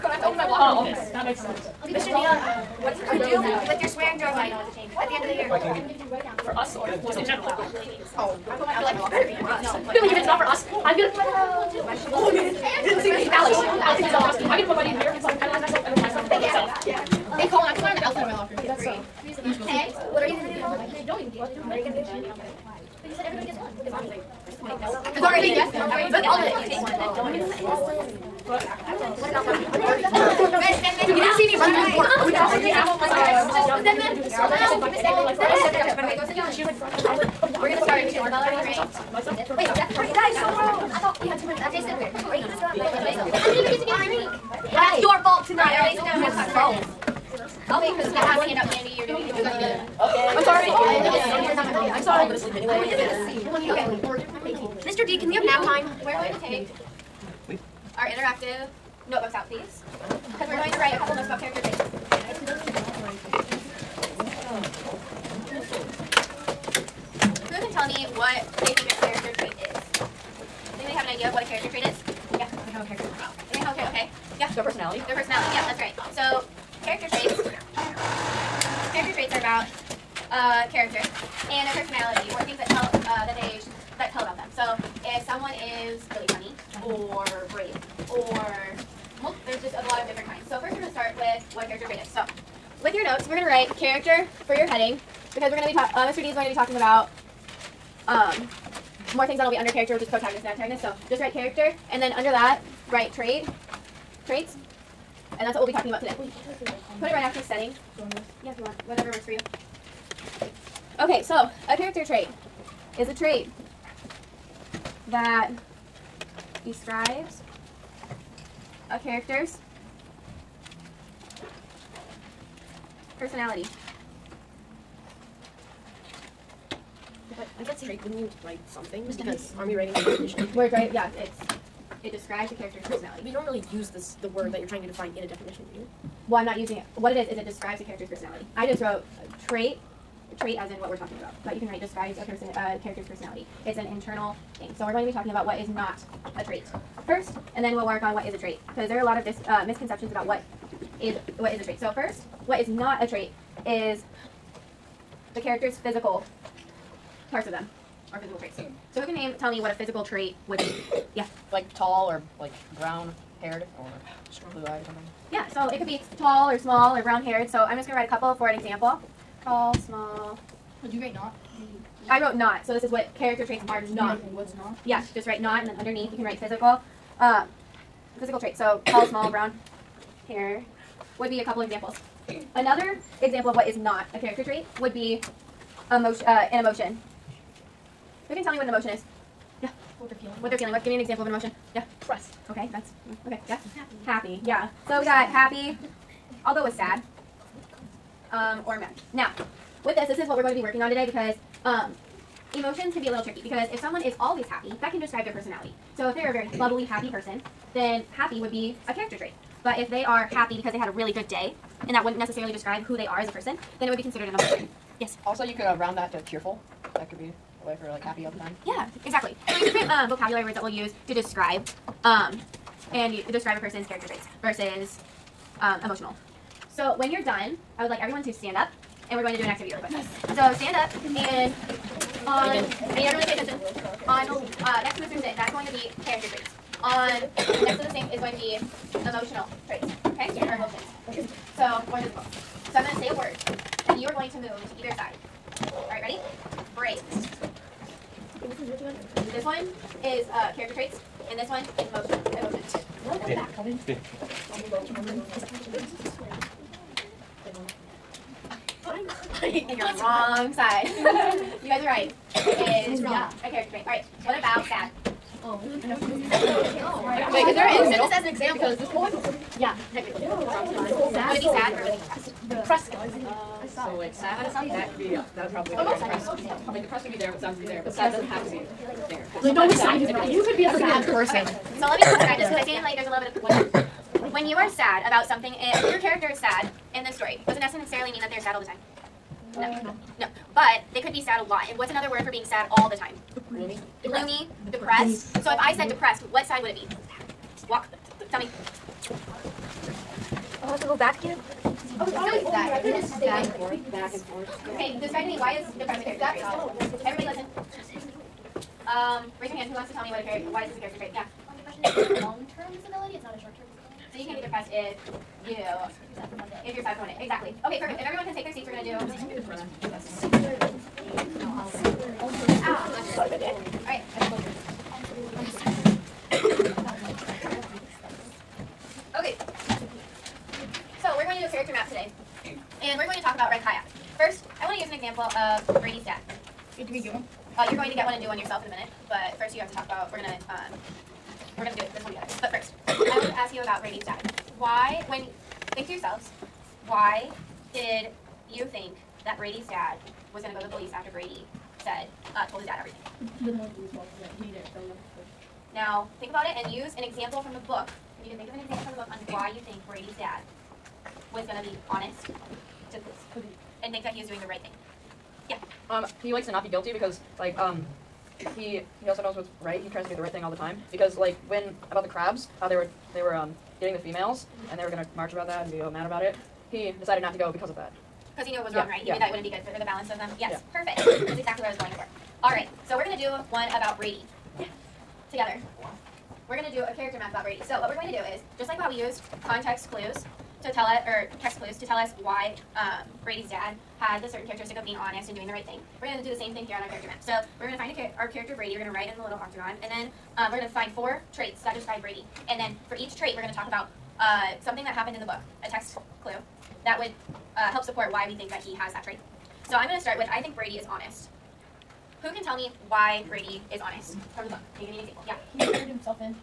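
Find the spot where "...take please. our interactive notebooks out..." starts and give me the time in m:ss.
0:56.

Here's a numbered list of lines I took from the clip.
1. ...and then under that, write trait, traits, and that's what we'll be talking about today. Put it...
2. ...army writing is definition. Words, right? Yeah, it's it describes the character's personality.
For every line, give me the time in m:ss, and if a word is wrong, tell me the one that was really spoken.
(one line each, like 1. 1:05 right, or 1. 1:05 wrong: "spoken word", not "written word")
1. 1:41 right
2. 2:09 right.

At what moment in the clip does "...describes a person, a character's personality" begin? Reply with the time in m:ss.
2:21.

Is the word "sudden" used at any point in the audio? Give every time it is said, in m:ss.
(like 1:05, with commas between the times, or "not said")
not said.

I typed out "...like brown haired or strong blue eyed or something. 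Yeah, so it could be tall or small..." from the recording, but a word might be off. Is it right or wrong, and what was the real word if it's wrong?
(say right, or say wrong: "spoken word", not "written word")
right.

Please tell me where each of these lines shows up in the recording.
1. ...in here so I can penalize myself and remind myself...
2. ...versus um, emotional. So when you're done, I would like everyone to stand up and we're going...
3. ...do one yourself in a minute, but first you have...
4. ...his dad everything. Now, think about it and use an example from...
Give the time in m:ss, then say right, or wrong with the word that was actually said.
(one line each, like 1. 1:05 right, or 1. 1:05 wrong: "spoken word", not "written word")
1. 0:14 right
2. 3:44 right
3. 5:38 right
4. 5:52 right.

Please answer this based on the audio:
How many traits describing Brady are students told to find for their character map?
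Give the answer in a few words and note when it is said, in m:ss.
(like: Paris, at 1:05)
4, at 6:40.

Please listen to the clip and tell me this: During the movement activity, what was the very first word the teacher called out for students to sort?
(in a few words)
Brave.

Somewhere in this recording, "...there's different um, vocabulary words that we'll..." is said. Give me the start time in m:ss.
3:39.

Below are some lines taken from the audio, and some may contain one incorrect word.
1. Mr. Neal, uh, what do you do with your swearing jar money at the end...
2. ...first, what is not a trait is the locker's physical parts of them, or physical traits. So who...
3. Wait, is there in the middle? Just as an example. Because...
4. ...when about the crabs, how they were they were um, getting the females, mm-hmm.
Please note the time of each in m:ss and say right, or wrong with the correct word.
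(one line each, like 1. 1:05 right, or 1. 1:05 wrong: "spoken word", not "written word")
1. 0:01 right
2. 2:31 wrong: "character", not "locker"
3. 4:27 right
4. 6:11 right.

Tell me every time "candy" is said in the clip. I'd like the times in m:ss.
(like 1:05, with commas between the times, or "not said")
0:05, 0:48.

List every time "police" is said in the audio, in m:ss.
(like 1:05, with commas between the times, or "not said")
5:50, 6:03.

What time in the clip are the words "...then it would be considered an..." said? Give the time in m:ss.
3:33.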